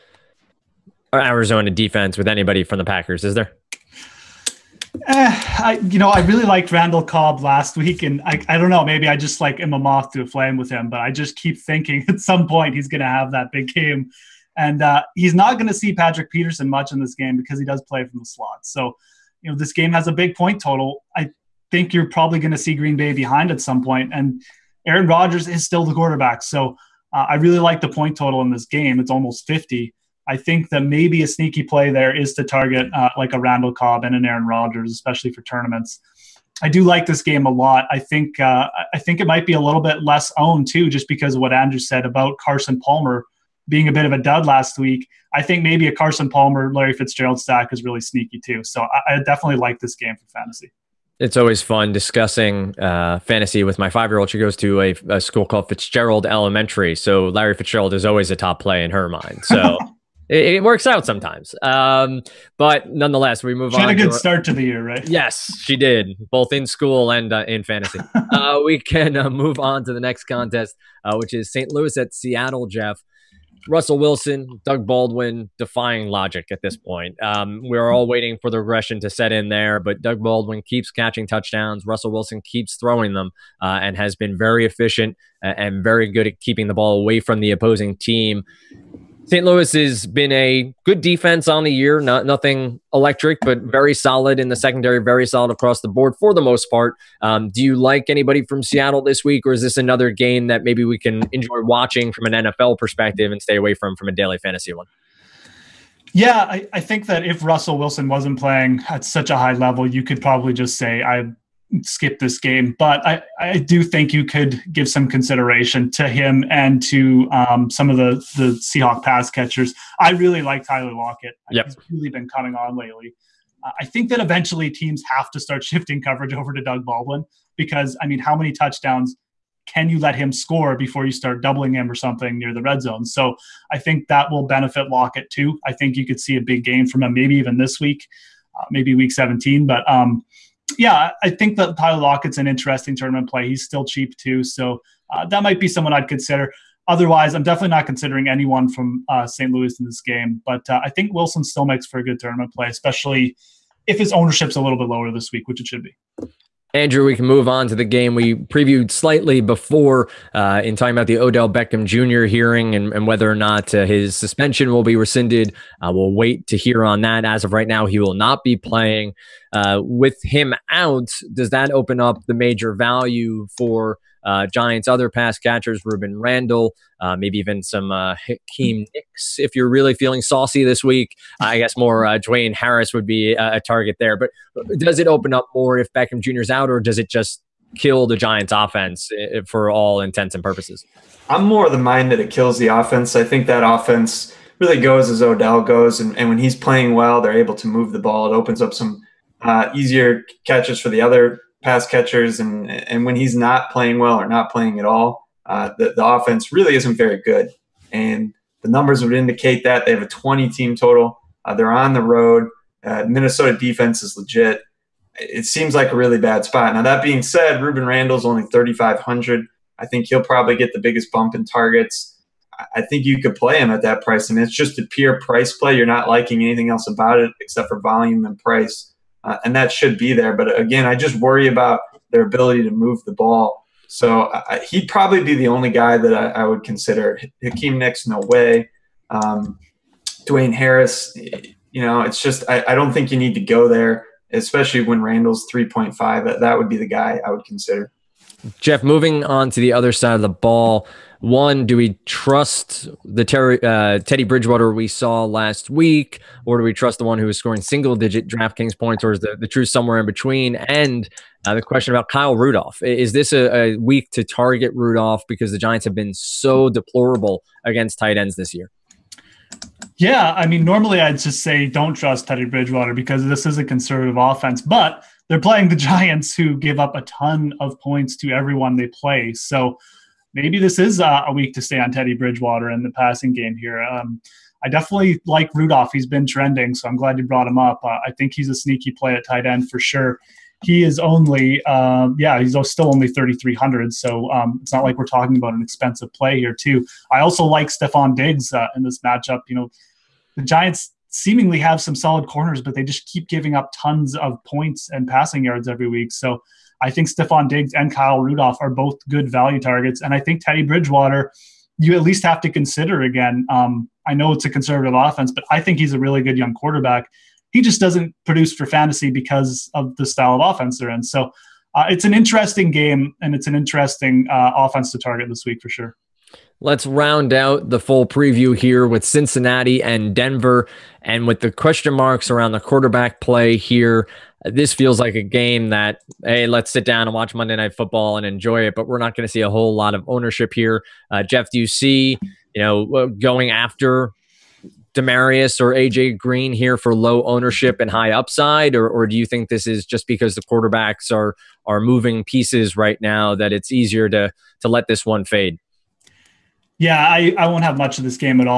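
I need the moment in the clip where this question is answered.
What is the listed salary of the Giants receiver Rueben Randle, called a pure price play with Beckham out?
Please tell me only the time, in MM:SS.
03:38.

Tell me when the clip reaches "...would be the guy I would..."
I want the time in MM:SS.
04:06.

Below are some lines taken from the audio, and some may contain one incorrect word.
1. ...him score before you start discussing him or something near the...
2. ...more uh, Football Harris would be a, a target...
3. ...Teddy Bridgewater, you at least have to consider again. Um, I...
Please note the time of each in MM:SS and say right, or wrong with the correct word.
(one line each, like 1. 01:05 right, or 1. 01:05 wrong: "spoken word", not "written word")
1. 02:10 wrong: "doubling", not "discussing"
2. 03:01 wrong: "Dwayne", not "Football"
3. 05:10 right.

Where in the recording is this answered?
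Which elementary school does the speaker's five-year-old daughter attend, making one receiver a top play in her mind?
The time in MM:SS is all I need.
00:55.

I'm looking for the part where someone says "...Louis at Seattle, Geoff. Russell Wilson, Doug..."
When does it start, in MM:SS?
01:11.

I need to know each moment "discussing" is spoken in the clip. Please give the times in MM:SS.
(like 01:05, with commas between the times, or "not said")
00:51.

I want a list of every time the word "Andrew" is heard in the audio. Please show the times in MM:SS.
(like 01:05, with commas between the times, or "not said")
00:41, 02:36.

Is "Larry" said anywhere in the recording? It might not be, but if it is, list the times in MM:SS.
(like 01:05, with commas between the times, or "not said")
00:46, 00:57.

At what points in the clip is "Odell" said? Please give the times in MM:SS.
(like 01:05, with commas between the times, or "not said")
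02:41, 03:15.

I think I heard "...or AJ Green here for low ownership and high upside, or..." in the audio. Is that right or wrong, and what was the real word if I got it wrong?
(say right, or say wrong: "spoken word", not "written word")
right.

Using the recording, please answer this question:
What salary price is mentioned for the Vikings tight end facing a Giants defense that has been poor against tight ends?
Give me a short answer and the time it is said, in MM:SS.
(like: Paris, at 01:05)
3,300, at 04:53.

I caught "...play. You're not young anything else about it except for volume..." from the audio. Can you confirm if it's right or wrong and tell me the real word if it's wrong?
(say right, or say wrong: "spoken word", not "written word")
wrong: "liking", not "young".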